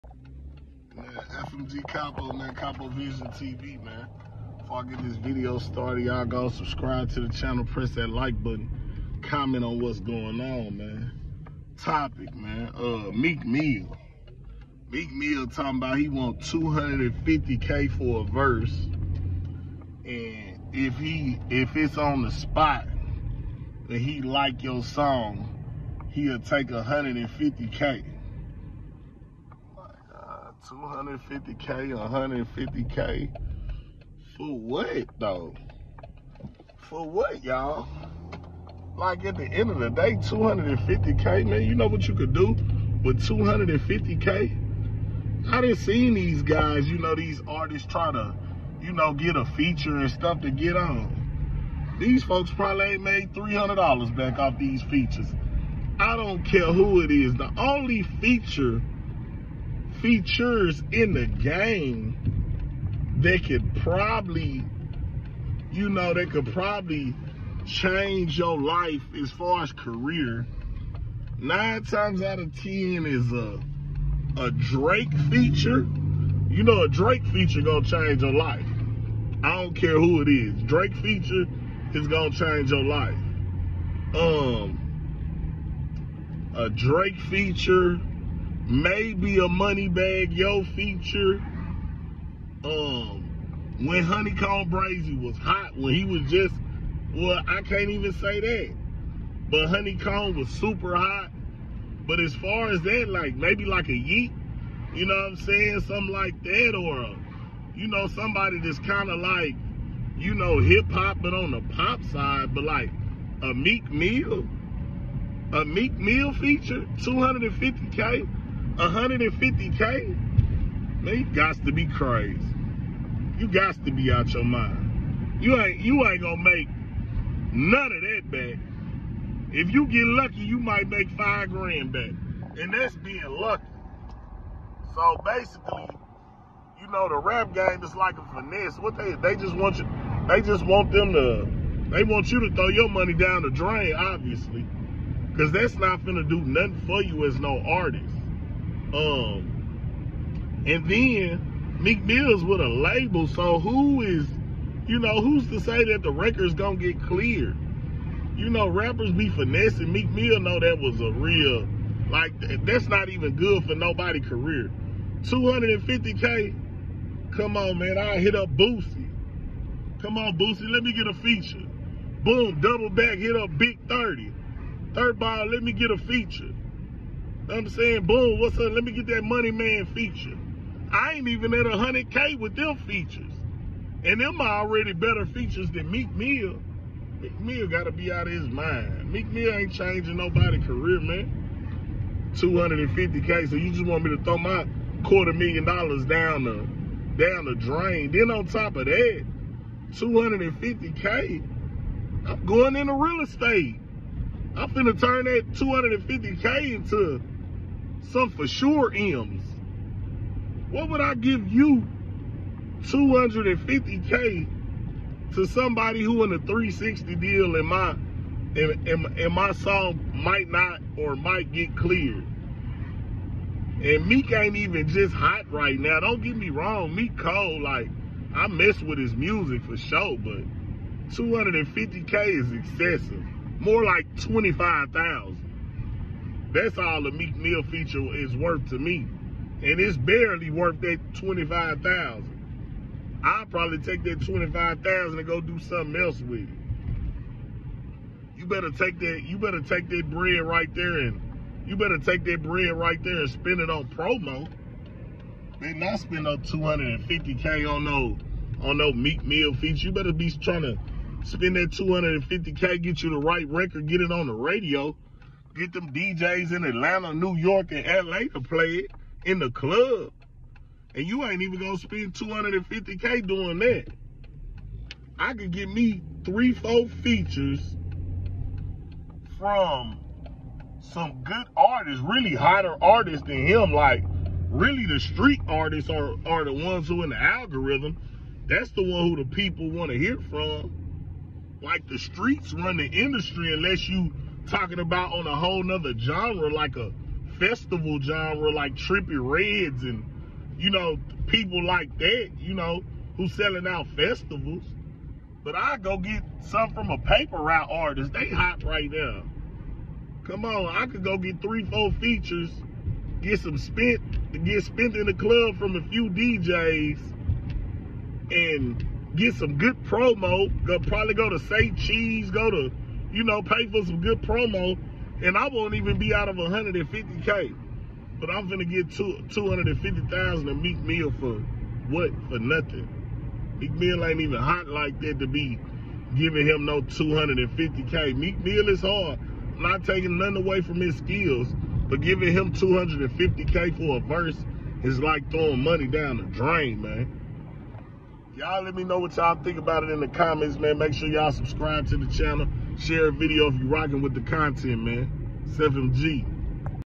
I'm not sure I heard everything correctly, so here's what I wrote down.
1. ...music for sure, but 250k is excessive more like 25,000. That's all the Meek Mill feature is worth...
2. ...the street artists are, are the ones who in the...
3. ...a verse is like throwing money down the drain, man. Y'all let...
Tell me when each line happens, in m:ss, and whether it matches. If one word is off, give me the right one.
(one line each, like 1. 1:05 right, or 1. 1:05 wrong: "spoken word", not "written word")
1. 3:49 right
2. 4:44 right
3. 5:43 right.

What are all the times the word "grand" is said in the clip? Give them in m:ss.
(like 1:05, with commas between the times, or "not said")
2:11.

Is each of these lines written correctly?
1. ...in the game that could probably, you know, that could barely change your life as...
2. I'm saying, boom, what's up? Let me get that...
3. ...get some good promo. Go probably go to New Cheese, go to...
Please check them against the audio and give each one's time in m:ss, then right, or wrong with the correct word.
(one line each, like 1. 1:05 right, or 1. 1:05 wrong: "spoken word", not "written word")
1. 1:00 wrong: "probably", not "barely"
2. 2:57 right
3. 5:19 wrong: "Say", not "New".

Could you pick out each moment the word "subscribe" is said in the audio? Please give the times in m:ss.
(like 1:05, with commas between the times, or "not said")
0:06, 5:51.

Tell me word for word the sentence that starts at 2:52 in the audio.
Boom, double back, hit up Big 30.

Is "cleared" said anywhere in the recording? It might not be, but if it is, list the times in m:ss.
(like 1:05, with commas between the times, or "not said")
2:37, 3:41.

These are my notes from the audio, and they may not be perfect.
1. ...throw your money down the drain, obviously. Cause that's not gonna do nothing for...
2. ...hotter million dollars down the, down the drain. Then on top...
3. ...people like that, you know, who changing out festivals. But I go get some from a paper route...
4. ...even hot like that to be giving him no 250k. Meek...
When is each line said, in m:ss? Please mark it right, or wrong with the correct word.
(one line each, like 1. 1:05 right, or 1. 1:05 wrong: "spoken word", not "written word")
1. 2:22 right
2. 3:15 wrong: "quarter", not "hotter"
3. 5:01 wrong: "selling", not "changing"
4. 5:34 right.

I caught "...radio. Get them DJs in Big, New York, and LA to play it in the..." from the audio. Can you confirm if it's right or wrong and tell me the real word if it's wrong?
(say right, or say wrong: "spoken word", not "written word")
wrong: "Atlanta", not "Big".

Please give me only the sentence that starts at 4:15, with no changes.
Then not spend up 250K on no on no Meek Mill feature.